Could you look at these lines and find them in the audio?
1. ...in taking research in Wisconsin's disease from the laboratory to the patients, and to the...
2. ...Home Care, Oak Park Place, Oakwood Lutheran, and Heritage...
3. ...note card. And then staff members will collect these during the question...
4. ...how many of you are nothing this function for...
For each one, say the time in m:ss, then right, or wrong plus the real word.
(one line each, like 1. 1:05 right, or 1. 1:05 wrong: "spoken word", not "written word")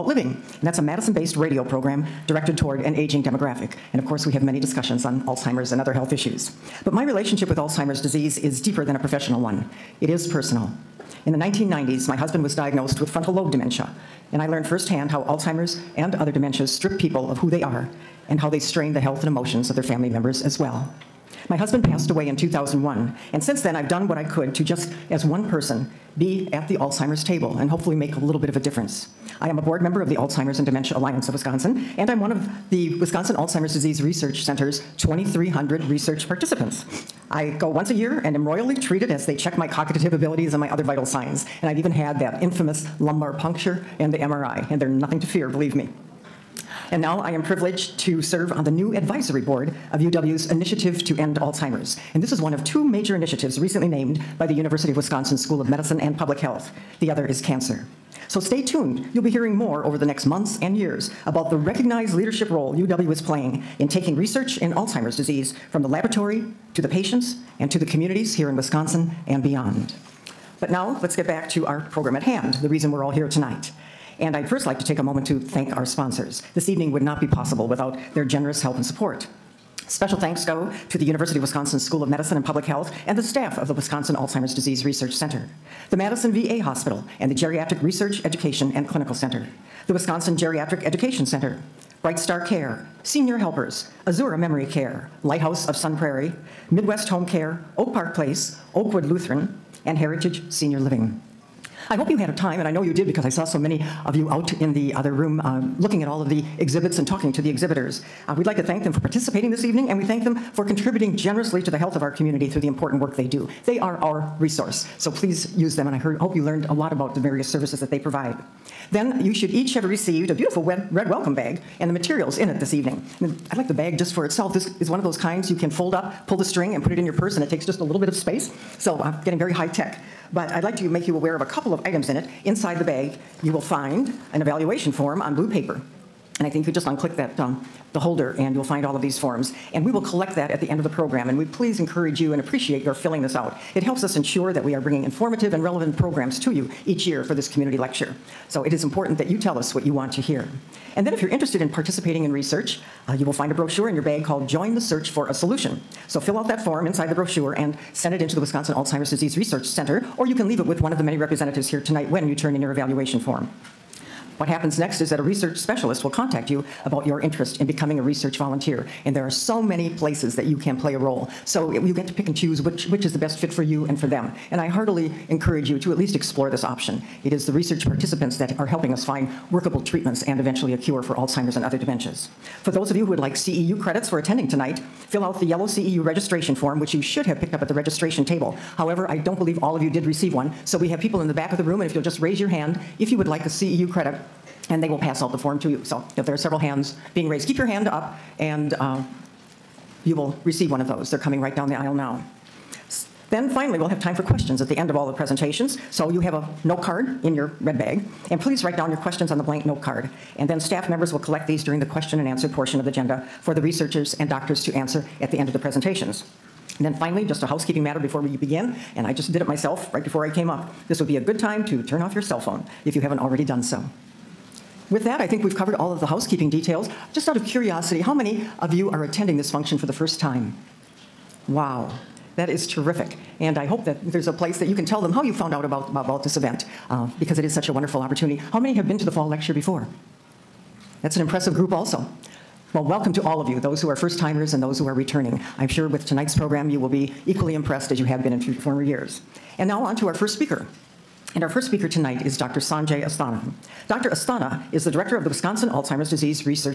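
1. 1:03 wrong: "Alzheimer", not "Wisconsin"
2. 1:37 right
3. 3:29 right
4. 3:47 wrong: "attending", not "nothing".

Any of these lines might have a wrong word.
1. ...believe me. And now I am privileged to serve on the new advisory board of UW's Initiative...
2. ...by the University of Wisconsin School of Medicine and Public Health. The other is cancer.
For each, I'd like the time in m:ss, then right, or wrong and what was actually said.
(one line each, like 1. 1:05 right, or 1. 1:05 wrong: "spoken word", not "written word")
1. 0:45 right
2. 0:54 right.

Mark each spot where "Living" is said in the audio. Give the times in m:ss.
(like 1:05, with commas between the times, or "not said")
0:00, 1:40.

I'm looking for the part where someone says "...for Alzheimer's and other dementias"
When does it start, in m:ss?
3:01.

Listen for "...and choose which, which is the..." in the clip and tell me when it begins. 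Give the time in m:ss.
2:52.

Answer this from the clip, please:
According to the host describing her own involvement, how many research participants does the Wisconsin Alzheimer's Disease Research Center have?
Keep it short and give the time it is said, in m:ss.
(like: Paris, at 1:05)
2,300, at 0:34.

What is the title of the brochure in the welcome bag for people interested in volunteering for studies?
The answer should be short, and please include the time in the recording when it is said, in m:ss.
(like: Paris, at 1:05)
Join the Search for a Solution, at 2:34.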